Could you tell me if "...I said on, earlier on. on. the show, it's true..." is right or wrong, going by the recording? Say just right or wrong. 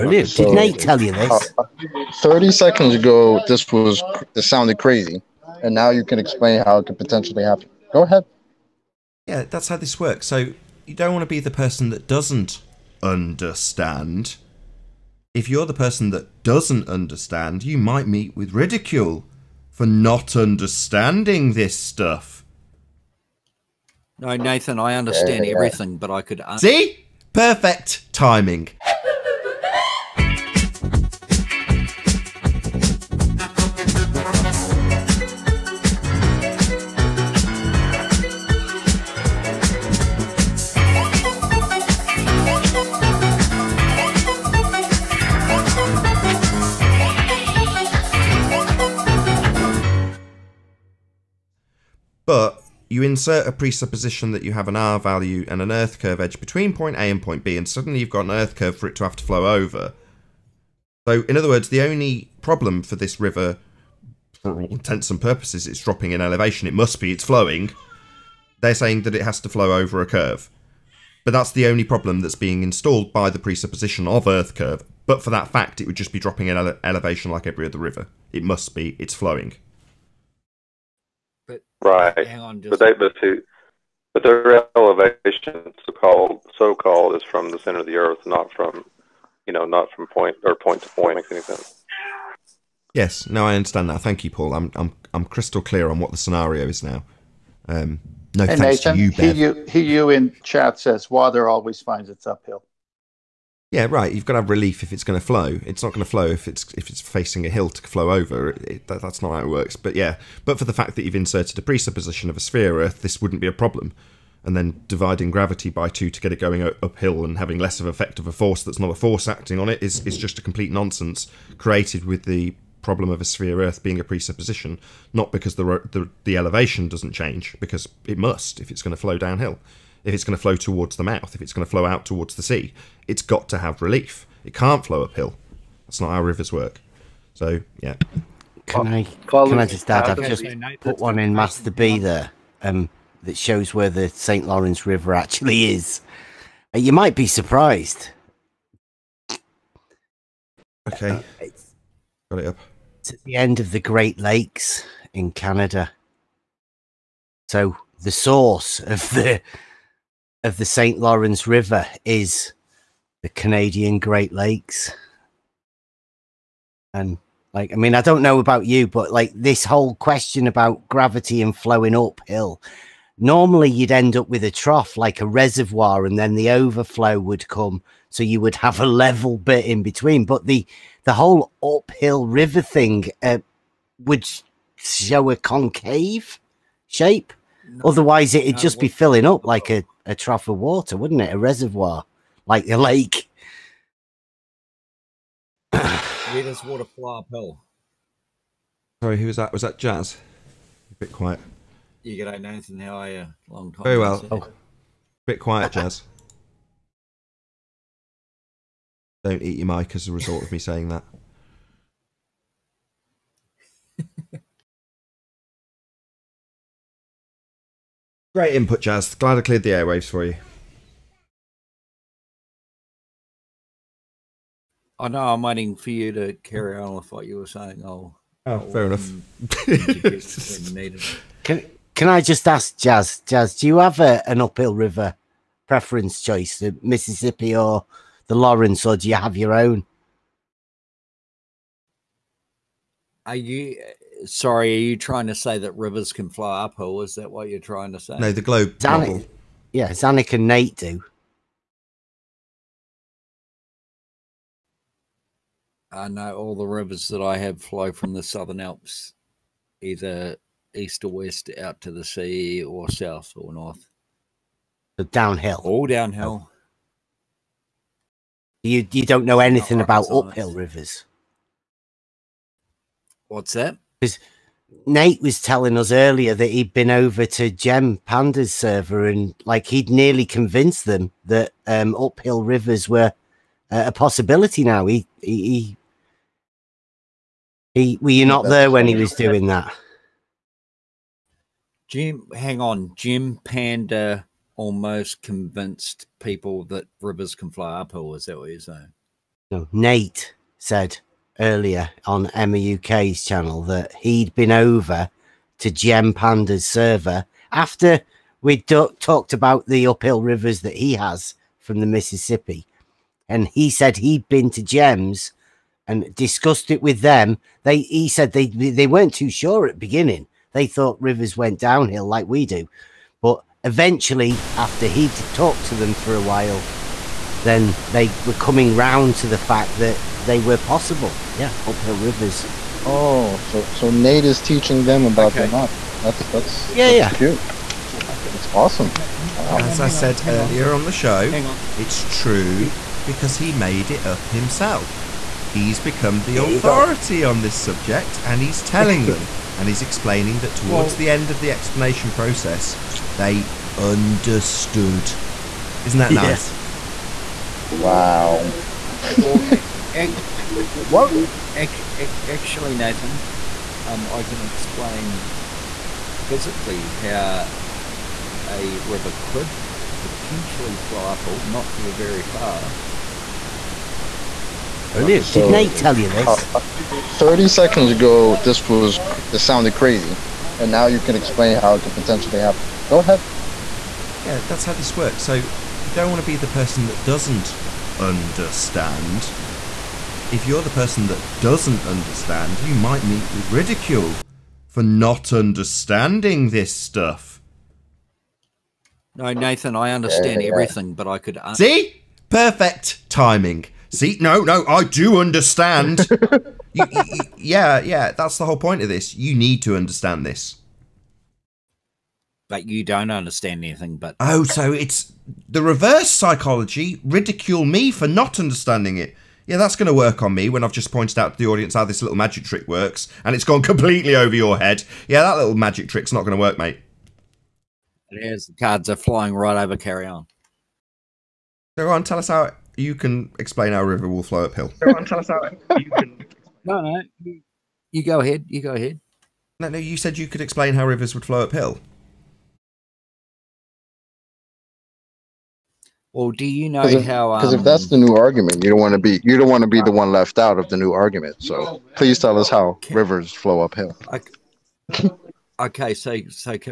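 right.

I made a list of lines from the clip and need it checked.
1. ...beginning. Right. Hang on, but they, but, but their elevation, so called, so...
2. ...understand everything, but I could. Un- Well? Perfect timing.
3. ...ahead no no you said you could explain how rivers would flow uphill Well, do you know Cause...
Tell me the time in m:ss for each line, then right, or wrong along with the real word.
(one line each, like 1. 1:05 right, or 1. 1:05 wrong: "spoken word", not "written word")
1. 1:19 wrong: "flowing", not "beginning"
2. 6:39 wrong: "See", not "Well"
3. 7:18 right.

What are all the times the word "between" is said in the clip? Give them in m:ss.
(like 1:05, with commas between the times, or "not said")
0:56, 2:59.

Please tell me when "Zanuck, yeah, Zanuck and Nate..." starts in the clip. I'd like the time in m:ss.
4:08.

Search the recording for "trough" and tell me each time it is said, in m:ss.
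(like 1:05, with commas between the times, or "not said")
2:54, 3:10.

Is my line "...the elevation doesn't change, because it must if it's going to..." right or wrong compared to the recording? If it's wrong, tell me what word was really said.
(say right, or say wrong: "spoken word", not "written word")
right.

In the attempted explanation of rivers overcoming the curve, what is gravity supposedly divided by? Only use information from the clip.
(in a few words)
2.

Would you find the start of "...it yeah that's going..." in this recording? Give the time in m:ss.
6:58.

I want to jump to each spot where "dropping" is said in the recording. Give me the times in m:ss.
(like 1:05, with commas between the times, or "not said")
1:05, 1:16.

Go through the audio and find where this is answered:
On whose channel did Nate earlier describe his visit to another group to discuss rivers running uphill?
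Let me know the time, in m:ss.
5:02.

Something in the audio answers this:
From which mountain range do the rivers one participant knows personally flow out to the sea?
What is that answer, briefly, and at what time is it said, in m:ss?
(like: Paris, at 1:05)
Southern Alps, at 4:18.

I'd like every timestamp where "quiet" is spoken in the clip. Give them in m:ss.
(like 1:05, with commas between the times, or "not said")
3:21, 3:25.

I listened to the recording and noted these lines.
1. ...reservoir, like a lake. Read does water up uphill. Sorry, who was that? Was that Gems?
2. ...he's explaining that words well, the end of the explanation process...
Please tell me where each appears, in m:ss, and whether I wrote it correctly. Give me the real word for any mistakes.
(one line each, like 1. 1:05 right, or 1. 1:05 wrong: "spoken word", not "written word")
1. 3:11 wrong: "Jazz", not "Gems"
2. 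5:49 wrong: "towards", not "words".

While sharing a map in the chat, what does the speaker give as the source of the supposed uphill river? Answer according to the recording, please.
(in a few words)
The Canadian Great Lakes.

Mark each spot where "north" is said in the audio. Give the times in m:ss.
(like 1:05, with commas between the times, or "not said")
4:23.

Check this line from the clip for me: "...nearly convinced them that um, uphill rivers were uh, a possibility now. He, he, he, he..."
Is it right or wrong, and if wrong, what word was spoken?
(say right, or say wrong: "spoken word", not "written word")
right.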